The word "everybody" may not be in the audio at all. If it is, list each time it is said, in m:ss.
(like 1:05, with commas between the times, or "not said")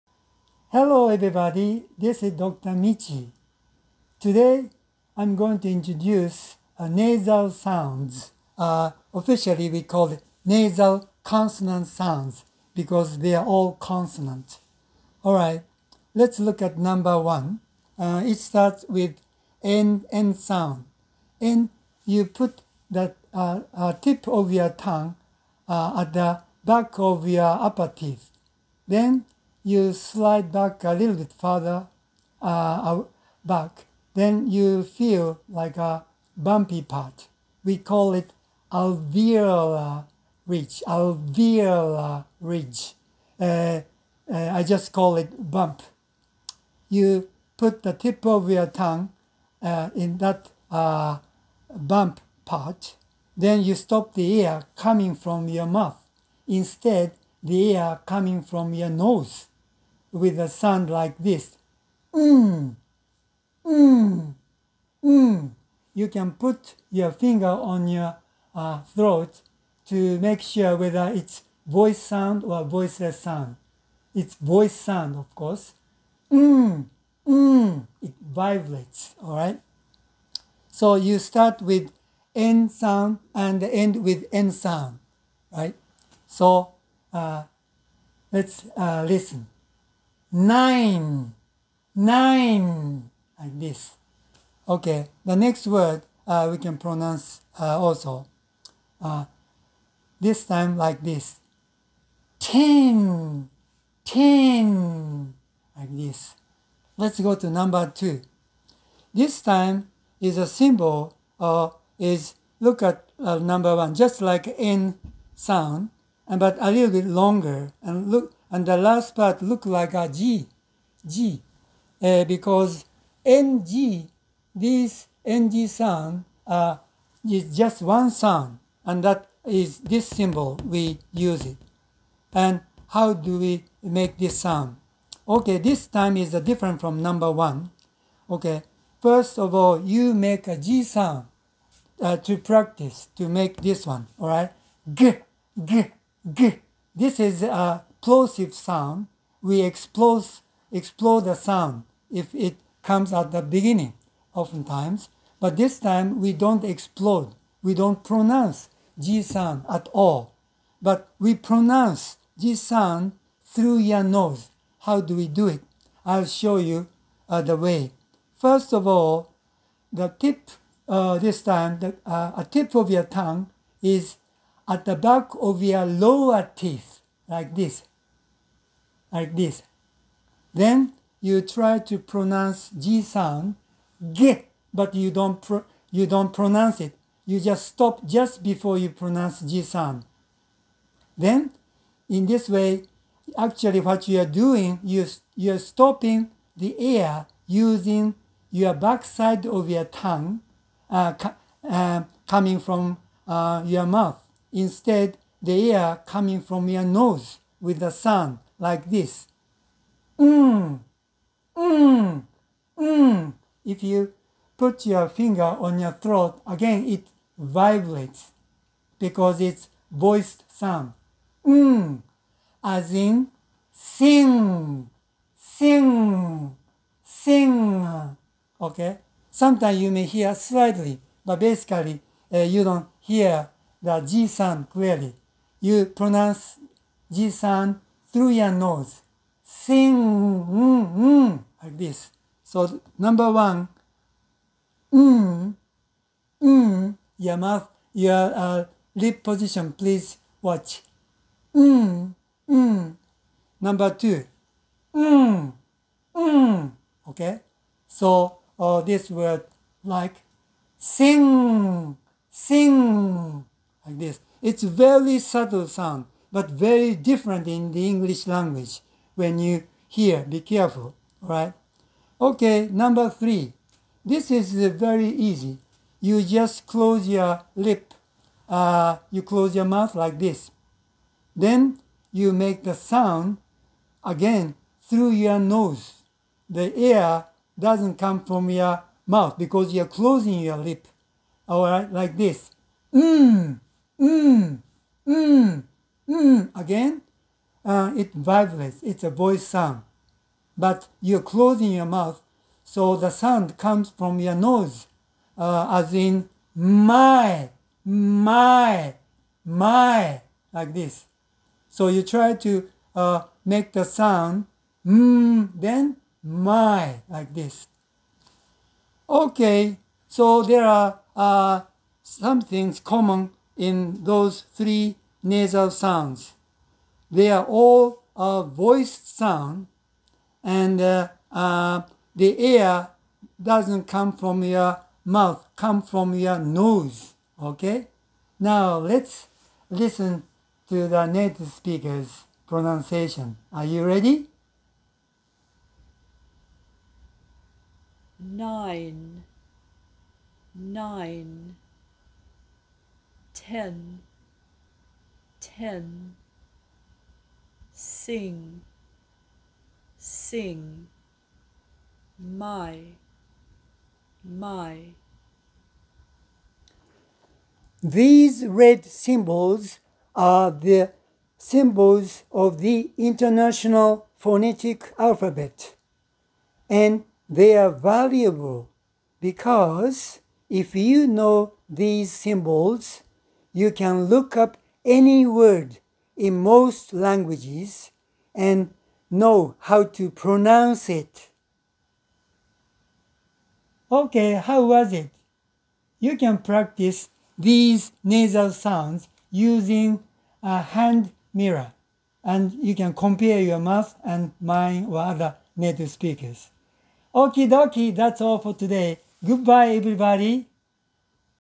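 0:01, 6:49.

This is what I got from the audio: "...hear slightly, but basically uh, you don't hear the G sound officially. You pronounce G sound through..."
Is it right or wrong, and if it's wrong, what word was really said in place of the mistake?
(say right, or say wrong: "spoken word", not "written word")
wrong: "clearly", not "officially".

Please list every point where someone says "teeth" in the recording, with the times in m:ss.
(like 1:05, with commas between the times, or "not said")
0:27, 2:56.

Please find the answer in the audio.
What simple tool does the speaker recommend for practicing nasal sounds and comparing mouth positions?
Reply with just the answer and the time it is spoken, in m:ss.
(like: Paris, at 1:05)
hand mirror, at 6:40.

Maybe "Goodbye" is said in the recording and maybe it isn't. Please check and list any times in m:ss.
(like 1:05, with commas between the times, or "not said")
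6:49.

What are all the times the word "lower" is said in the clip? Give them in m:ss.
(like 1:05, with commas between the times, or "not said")
2:55.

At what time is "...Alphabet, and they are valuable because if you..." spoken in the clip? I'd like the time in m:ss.
6:14.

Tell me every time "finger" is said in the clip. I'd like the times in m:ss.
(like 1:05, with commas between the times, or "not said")
1:07, 3:35.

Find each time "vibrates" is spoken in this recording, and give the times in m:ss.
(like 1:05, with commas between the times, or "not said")
1:18, 3:37, 4:58.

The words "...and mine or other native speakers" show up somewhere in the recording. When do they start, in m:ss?
6:44.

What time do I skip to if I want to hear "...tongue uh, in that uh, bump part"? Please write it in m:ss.
0:48.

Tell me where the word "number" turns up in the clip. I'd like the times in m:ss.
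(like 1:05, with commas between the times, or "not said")
0:16, 1:47, 1:53, 2:17, 4:02, 4:13, 4:32.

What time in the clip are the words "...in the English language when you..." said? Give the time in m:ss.
4:27.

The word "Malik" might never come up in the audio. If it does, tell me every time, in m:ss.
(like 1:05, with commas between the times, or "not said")
not said.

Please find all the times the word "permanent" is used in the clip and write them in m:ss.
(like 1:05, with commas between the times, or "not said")
not said.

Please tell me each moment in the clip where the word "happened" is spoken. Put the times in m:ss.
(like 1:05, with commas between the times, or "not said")
not said.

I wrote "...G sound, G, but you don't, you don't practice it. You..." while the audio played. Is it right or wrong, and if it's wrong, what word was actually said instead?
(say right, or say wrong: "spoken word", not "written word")
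wrong: "pronounce", not "practice".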